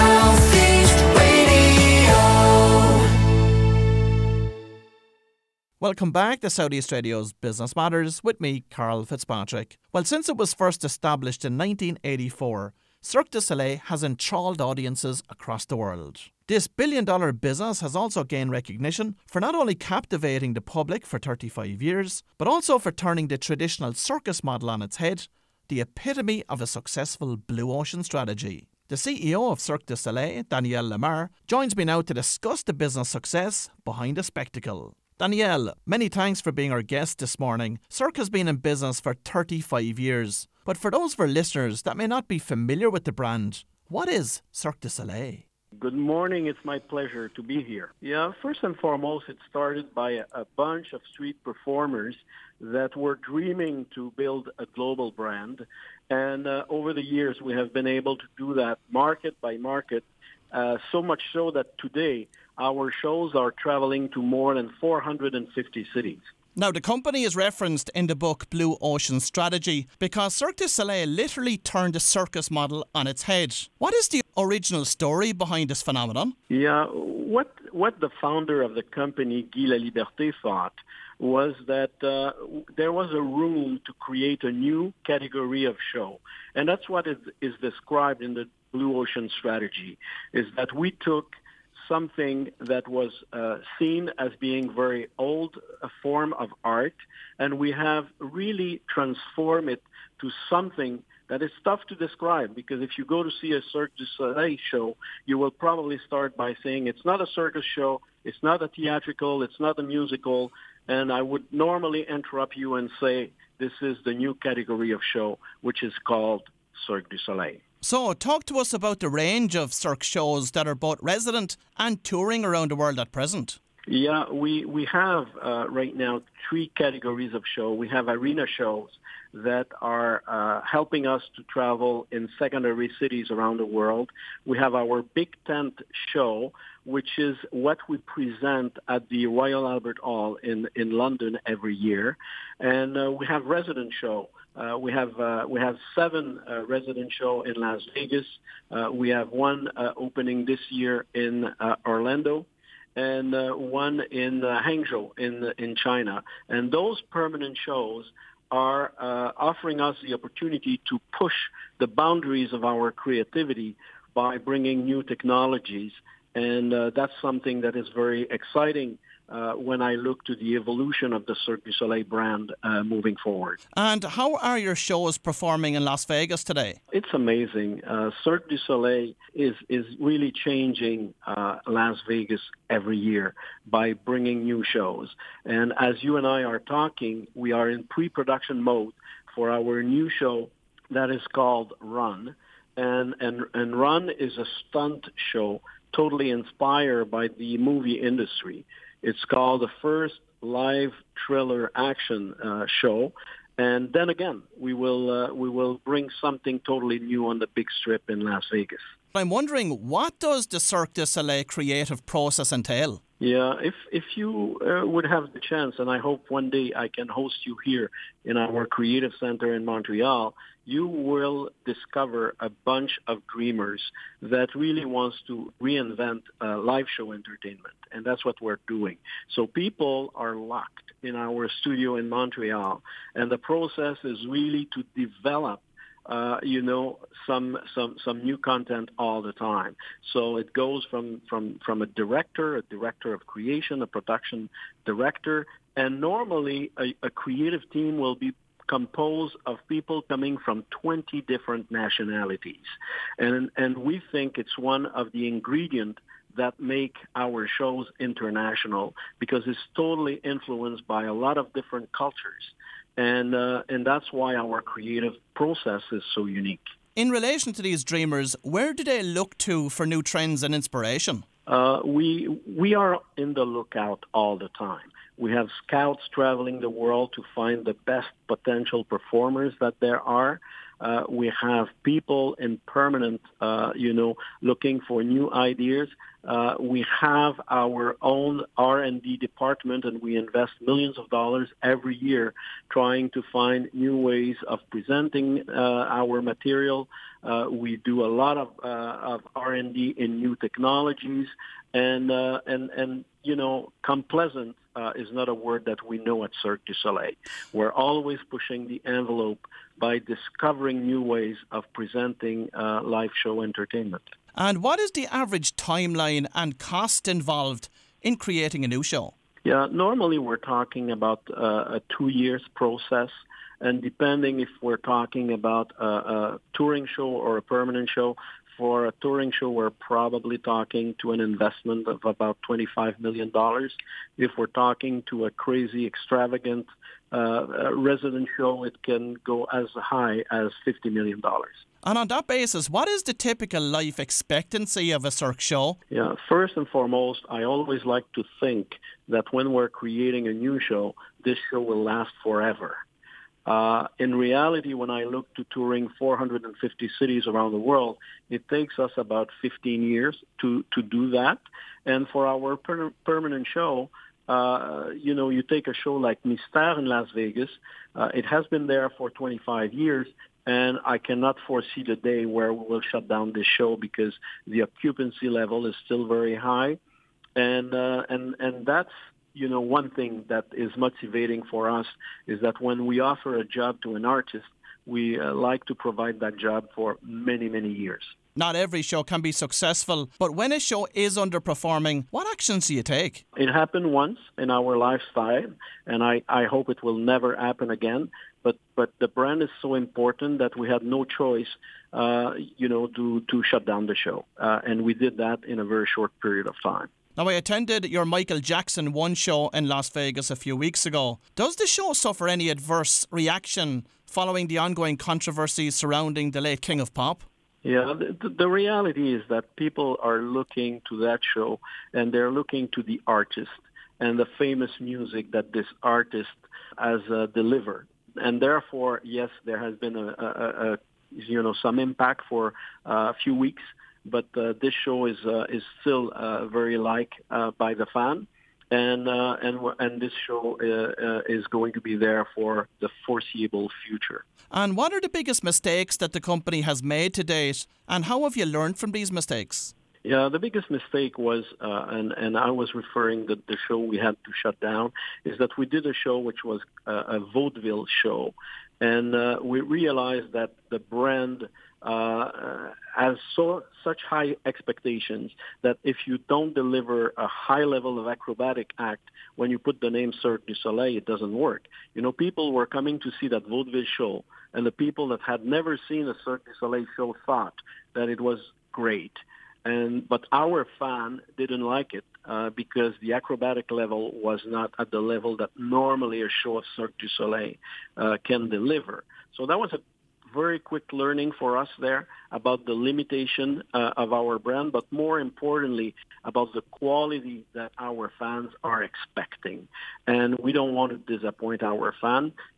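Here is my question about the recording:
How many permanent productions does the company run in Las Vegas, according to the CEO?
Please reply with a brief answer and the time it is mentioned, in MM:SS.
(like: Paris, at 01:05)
7, at 02:25.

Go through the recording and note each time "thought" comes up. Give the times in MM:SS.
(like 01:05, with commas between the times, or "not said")
01:20, 07:57.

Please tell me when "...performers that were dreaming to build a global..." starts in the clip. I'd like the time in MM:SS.
00:51.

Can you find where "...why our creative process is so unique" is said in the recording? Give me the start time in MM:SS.
04:24.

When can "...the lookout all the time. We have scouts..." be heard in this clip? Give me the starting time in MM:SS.
04:33.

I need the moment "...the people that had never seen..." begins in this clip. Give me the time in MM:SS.
07:54.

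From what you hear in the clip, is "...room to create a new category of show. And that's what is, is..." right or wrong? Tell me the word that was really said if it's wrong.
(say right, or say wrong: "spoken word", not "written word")
right.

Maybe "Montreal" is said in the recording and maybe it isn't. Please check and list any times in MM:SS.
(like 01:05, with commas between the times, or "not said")
03:39, 03:52.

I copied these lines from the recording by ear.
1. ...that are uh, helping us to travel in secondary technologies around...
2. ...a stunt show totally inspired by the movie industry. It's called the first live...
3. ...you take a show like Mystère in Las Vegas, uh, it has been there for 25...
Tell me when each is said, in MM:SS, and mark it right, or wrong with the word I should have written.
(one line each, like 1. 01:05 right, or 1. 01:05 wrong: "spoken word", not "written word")
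1. 02:09 wrong: "cities", not "technologies"
2. 03:14 right
3. 06:05 right.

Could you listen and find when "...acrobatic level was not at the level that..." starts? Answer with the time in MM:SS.
08:03.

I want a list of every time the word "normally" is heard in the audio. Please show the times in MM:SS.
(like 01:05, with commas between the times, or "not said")
01:51, 04:06, 05:19, 08:05.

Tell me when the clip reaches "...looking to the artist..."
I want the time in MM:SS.
07:02.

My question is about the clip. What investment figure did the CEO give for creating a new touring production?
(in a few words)
$25 million.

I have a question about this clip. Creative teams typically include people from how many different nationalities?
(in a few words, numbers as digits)
20.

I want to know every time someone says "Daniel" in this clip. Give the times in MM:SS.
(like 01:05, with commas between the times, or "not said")
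00:30, 00:35.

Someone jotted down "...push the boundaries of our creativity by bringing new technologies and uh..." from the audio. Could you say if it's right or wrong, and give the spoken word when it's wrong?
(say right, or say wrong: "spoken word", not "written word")
right.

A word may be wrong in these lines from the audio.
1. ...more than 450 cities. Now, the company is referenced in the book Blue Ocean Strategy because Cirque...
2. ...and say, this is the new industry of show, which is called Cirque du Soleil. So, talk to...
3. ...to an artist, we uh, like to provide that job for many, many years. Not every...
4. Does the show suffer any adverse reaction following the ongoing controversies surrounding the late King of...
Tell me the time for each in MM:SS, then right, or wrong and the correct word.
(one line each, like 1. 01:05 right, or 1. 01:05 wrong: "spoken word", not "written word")
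1. 01:04 right
2. 01:52 wrong: "category", not "industry"
3. 06:23 right
4. 06:51 right.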